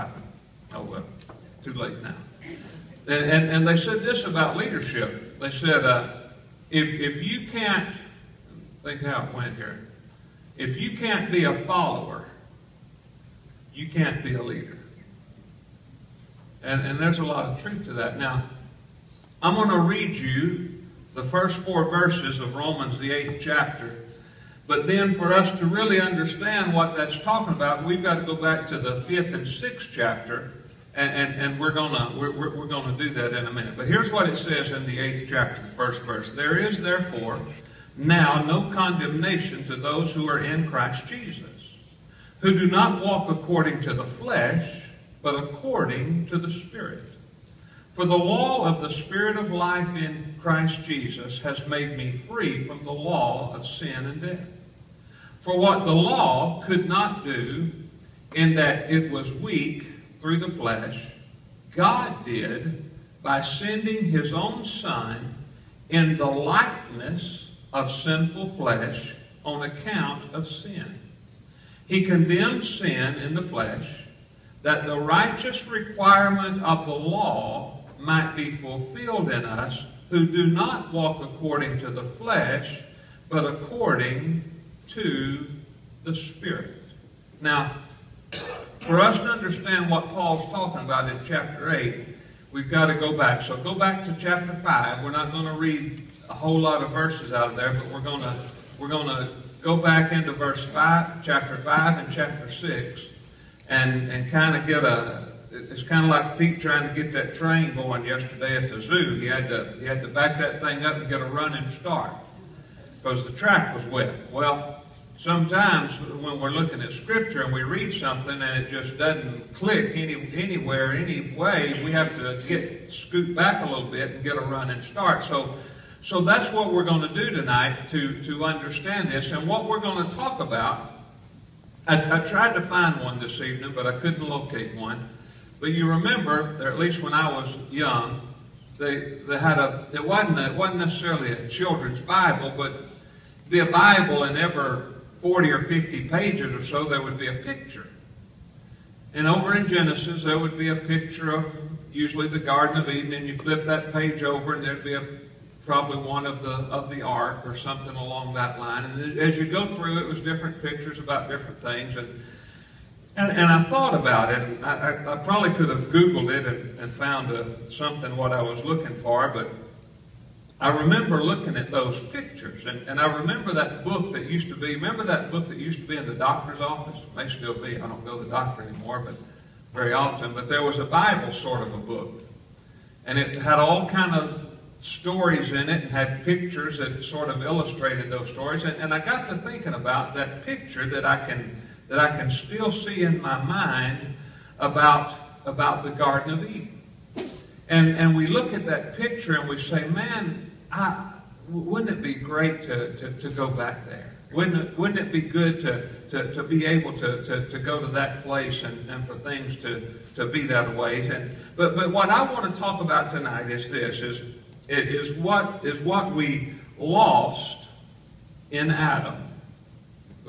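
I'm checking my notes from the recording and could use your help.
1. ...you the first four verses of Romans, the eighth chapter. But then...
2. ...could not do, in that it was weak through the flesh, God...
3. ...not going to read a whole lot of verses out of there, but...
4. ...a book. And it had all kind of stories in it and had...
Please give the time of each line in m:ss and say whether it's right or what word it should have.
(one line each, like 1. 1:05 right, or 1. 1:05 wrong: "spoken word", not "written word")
1. 0:20 right
2. 0:56 right
3. 1:35 right
4. 3:01 right.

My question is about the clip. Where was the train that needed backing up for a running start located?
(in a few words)
the zoo.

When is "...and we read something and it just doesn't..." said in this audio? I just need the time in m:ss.
1:57.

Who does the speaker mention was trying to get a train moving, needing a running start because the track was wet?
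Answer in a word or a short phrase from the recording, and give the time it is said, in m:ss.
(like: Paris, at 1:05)
Pete, at 1:46.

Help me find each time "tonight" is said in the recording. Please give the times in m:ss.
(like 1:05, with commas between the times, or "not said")
2:07, 3:33.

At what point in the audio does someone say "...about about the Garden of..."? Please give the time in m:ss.
3:14.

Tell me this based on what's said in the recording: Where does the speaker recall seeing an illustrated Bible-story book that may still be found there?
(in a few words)
the doctor's office.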